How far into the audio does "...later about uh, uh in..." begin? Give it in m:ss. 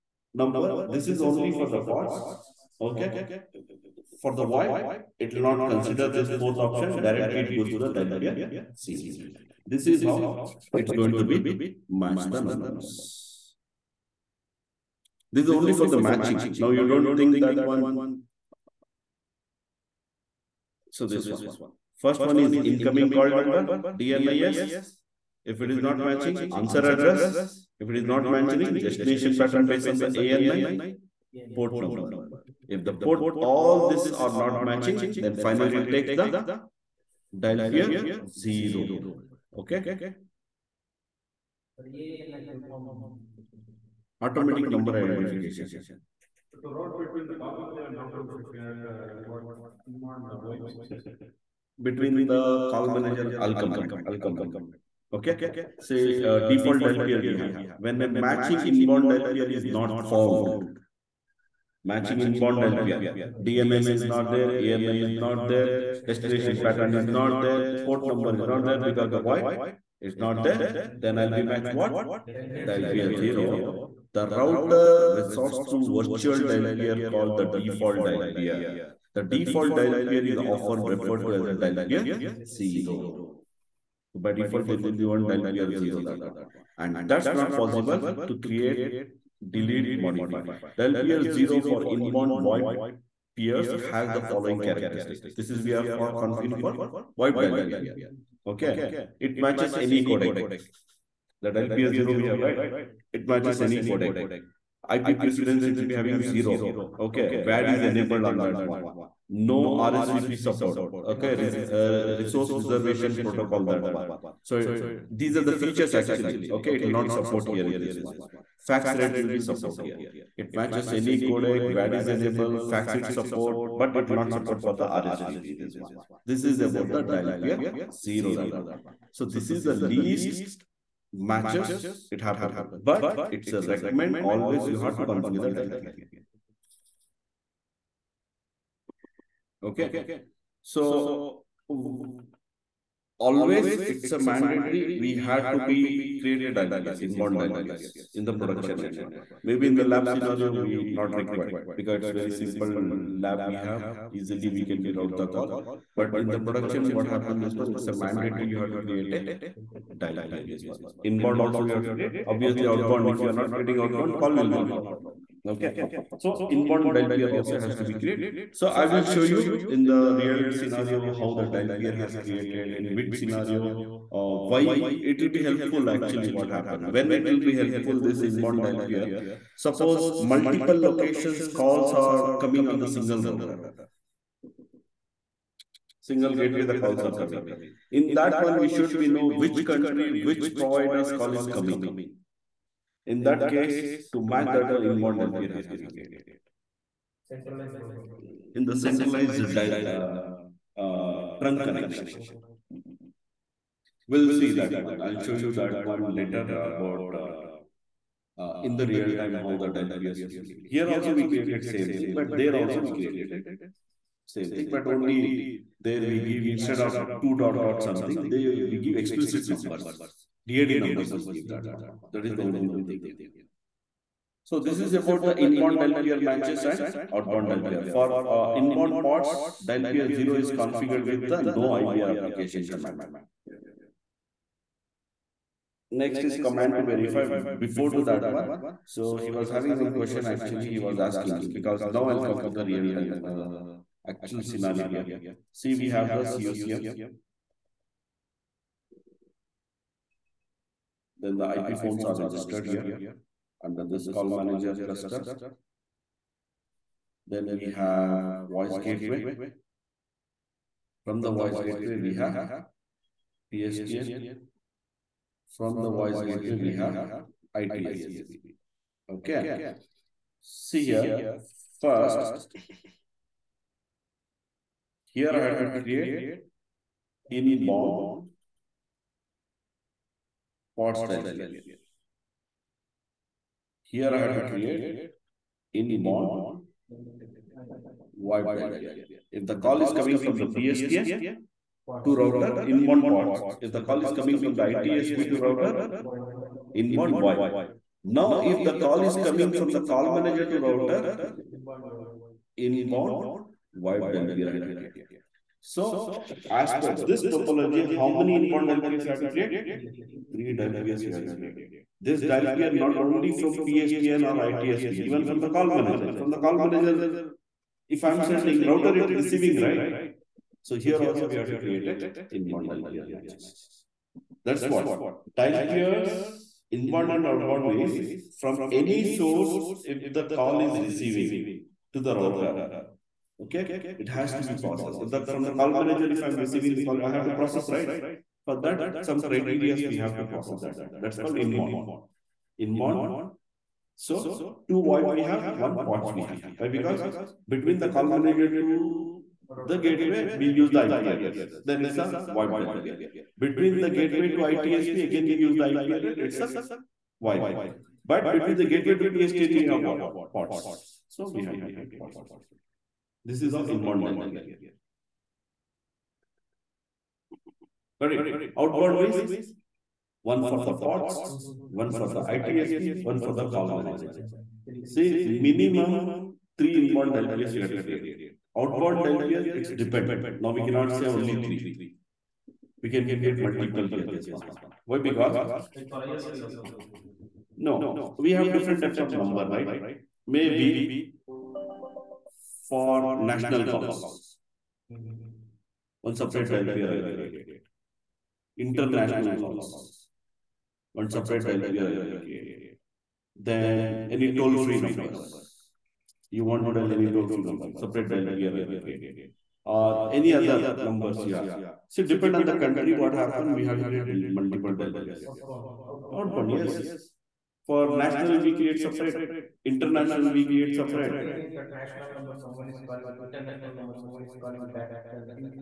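3:26.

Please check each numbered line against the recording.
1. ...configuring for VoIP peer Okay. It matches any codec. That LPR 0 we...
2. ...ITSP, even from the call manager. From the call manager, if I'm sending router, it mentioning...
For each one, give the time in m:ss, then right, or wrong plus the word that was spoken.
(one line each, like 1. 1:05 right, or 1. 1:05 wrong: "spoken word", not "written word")
1. 1:36 right
2. 5:14 wrong: "receiving", not "mentioning".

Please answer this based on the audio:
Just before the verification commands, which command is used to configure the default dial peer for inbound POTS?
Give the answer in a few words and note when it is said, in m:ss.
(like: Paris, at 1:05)
no IVR application, at 3:51.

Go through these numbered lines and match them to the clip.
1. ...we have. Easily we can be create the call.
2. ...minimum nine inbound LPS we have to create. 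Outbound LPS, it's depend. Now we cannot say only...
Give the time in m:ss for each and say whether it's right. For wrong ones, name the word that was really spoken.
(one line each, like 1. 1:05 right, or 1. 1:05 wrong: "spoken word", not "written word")
1. 2:33 wrong: "route", not "create"
2. 6:15 wrong: "three", not "nine".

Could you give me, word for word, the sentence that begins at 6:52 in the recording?
depend on the country, what happened, we have to create multiple DLPS.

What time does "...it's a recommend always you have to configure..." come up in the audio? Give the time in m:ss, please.
2:13.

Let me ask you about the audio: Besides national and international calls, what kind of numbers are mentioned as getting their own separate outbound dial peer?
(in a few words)
Toll free numbers.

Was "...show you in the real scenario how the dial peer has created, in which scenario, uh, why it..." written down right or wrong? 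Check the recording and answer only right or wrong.
right.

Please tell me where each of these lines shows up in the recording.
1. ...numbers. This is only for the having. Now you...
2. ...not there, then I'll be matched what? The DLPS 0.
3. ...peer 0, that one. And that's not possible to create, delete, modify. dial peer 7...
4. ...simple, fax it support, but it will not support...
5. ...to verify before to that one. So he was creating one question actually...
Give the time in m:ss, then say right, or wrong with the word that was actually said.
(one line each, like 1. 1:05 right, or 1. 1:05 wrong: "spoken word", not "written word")
1. 0:12 wrong: "matching", not "having"
2. 1:10 wrong: "LPR", not "DLPS"
3. 1:25 wrong: "0", not "7"
4. 2:02 wrong: "enable", not "simple"
5. 3:56 wrong: "having", not "creating".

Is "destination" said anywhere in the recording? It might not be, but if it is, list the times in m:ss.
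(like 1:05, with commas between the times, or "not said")
0:28, 1:06.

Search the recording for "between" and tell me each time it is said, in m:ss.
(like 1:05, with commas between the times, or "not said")
0:46, 0:51, 5:47, 5:53, 5:58.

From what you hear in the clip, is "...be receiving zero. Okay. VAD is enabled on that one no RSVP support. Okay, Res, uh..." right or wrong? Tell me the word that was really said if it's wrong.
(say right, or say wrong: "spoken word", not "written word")
wrong: "having", not "receiving".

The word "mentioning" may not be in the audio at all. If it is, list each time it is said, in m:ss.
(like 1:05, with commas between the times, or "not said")
0:28.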